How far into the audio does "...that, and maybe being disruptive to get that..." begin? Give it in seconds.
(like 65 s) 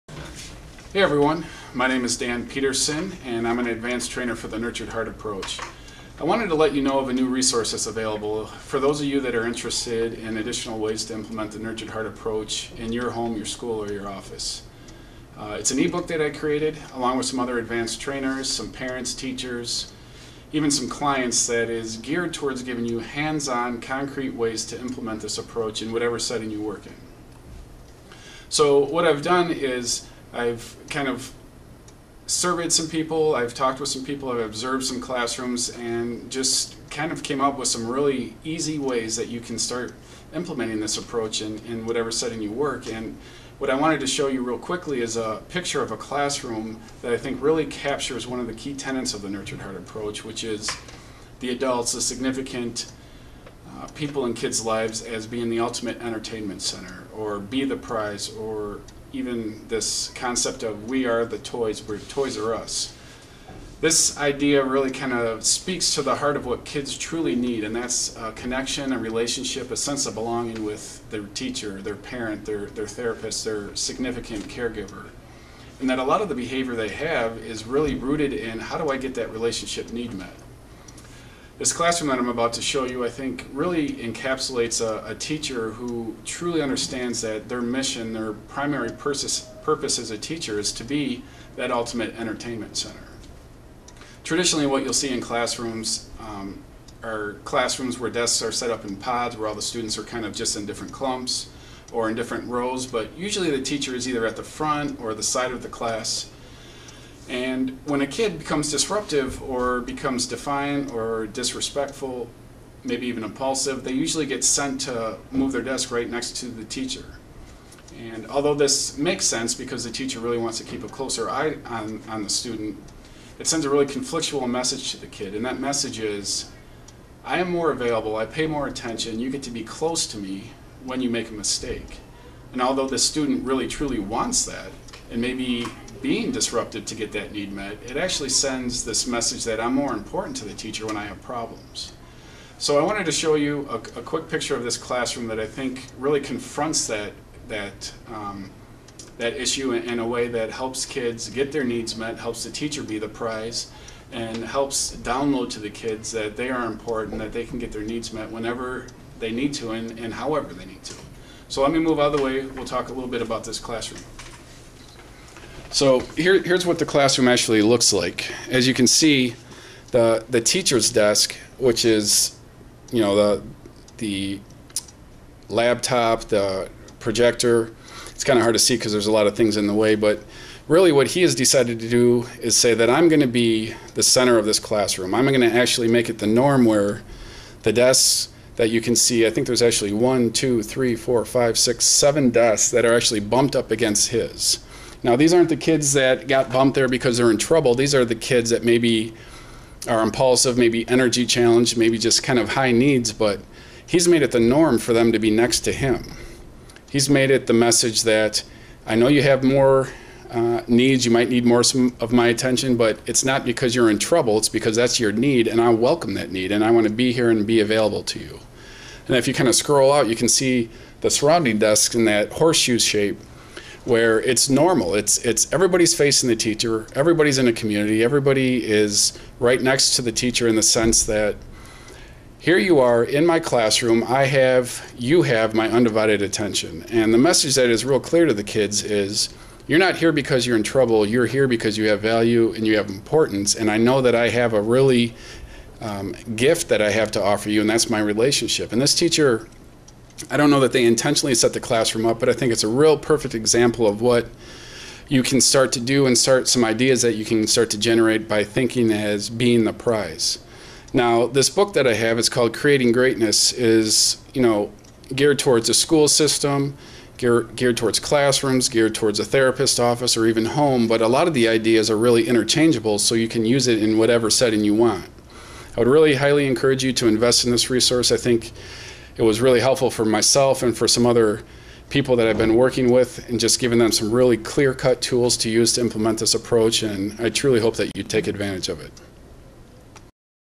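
134 s.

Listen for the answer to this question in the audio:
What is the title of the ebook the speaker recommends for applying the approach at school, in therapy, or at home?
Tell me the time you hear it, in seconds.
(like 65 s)
262 s.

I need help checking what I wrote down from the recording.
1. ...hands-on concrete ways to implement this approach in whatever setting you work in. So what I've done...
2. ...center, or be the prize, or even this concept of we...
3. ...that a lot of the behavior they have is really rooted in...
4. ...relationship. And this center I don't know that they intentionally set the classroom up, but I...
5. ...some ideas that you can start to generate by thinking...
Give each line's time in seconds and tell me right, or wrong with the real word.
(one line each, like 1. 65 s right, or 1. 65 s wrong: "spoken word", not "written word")
1. 22 s right
2. 56 s right
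3. 75 s right
4. 247 s wrong: "teacher", not "center"
5. 256 s right.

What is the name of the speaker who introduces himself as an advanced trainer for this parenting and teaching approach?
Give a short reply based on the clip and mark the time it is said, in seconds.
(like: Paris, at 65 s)
Dan Peterson, at 2 s.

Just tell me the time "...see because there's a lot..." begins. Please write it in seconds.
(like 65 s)
178 s.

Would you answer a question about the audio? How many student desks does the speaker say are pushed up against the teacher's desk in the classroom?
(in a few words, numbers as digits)
7.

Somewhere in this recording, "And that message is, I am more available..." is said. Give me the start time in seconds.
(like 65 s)
125 s.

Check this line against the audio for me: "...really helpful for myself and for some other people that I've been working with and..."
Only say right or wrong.
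right.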